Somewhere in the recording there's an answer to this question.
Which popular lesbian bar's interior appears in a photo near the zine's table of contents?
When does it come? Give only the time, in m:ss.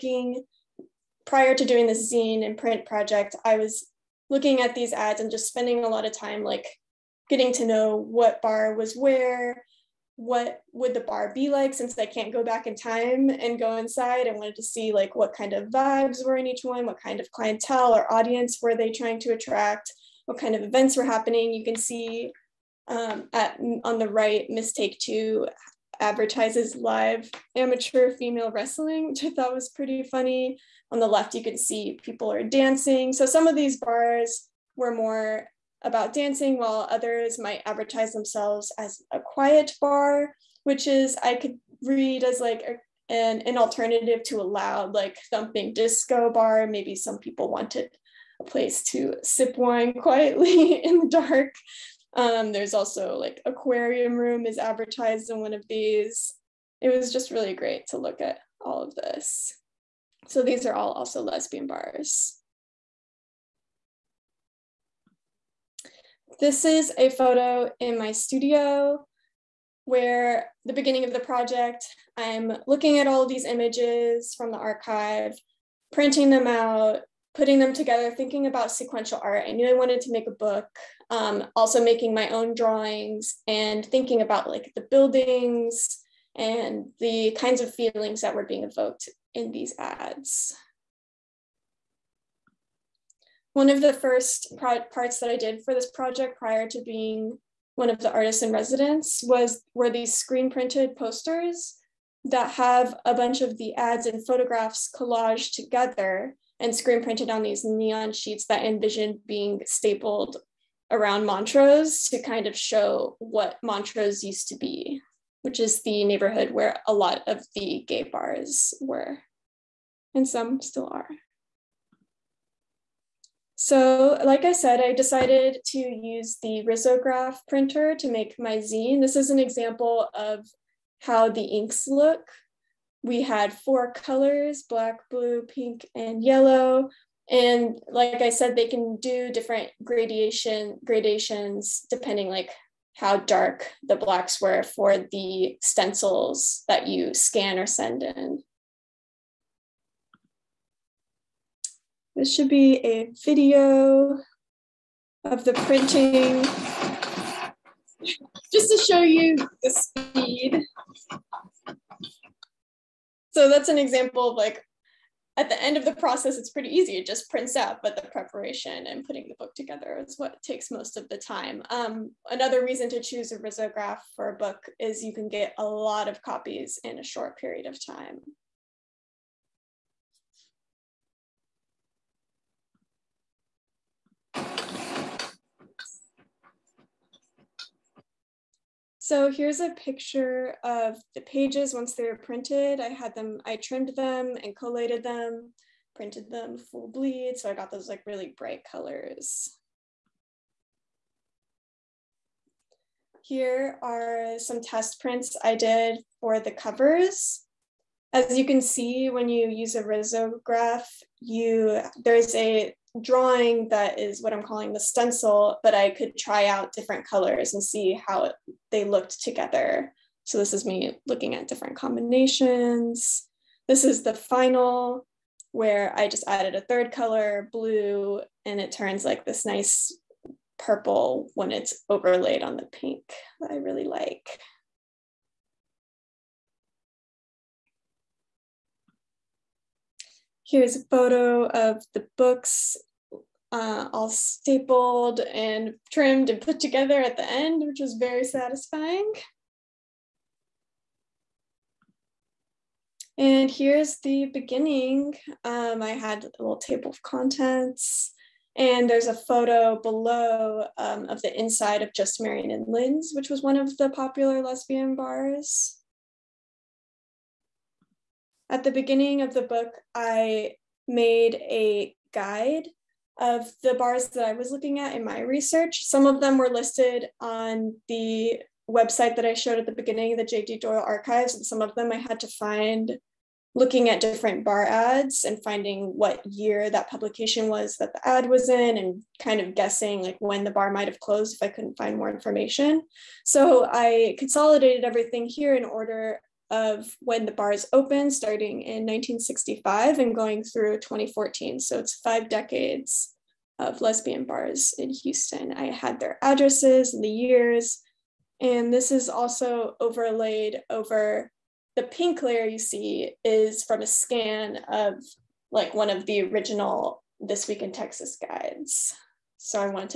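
4:21.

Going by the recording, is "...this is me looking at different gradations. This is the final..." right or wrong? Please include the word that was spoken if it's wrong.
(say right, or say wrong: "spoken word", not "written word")
wrong: "combinations", not "gradations".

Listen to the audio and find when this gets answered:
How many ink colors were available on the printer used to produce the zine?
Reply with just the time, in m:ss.
2:13.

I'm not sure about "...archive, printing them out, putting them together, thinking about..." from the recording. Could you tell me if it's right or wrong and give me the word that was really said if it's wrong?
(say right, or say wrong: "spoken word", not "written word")
right.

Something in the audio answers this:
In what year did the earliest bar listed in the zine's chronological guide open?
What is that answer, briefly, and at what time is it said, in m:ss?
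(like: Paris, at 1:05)
1965, at 4:58.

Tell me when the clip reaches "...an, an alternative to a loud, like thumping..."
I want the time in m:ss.
0:43.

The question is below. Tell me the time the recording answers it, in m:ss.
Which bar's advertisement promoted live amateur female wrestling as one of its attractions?
0:24.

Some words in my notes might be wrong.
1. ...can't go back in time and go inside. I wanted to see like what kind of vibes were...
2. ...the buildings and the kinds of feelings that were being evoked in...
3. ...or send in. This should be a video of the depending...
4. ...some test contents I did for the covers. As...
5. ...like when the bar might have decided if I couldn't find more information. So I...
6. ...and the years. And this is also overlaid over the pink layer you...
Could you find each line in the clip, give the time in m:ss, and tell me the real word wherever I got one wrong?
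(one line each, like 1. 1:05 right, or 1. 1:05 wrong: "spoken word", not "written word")
1. 0:12 right
2. 1:24 right
3. 2:27 wrong: "printing", not "depending"
4. 3:24 wrong: "prints", not "contents"
5. 4:50 wrong: "closed", not "decided"
6. 5:06 right.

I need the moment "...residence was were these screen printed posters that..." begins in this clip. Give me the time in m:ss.
1:38.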